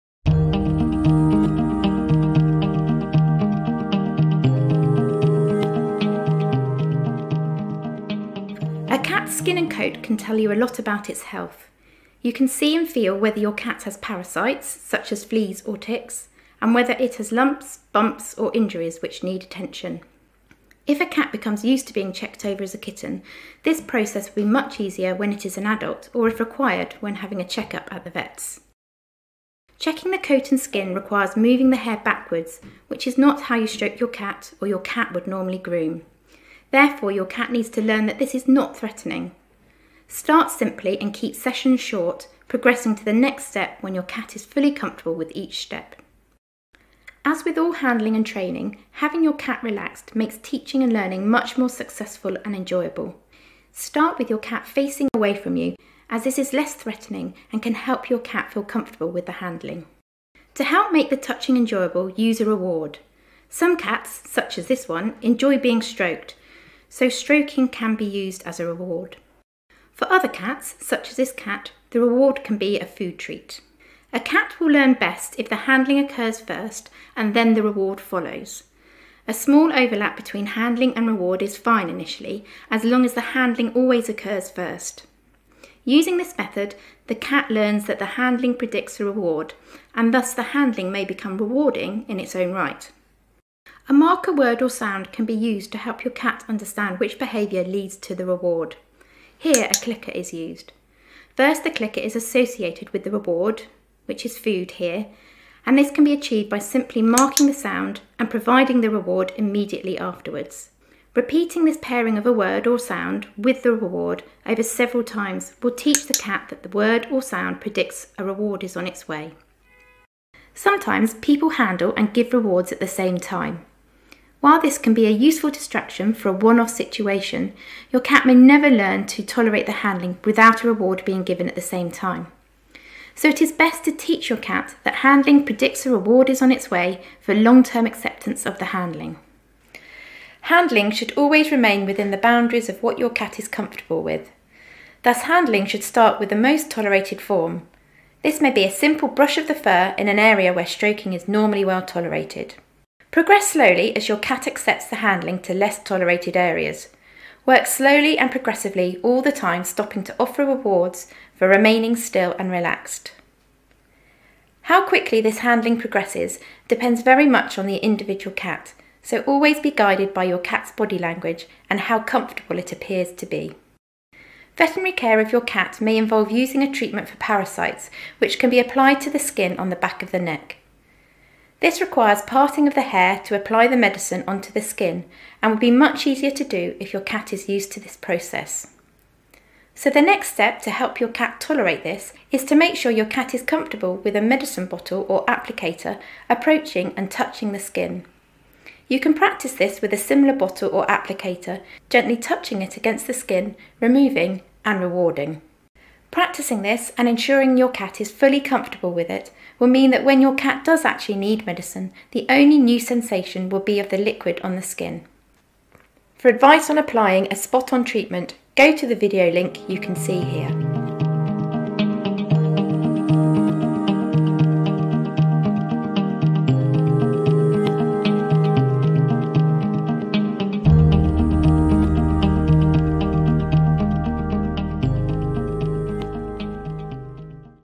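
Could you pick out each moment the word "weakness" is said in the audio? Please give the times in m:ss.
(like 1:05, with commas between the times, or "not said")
not said.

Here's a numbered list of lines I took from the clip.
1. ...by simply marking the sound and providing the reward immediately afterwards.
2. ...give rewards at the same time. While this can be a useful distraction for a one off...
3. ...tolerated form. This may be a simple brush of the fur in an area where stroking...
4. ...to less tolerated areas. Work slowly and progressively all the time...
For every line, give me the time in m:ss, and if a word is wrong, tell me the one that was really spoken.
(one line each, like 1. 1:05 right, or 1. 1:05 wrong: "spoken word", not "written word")
1. 1:46 right
2. 2:02 right
3. 2:26 right
4. 2:35 right.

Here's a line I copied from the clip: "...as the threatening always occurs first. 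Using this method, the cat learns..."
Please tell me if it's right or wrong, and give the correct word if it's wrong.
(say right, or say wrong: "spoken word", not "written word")
wrong: "handling", not "threatening".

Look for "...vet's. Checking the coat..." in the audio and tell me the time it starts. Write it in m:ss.
0:28.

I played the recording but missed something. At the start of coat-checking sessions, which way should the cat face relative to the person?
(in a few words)
away from you.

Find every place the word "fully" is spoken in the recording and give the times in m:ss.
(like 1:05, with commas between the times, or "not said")
0:44, 3:28.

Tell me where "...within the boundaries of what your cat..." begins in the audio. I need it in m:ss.
2:21.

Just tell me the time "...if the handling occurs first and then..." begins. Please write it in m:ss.
1:15.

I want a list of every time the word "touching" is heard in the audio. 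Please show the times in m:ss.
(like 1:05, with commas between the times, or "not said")
1:01, 3:17, 3:22.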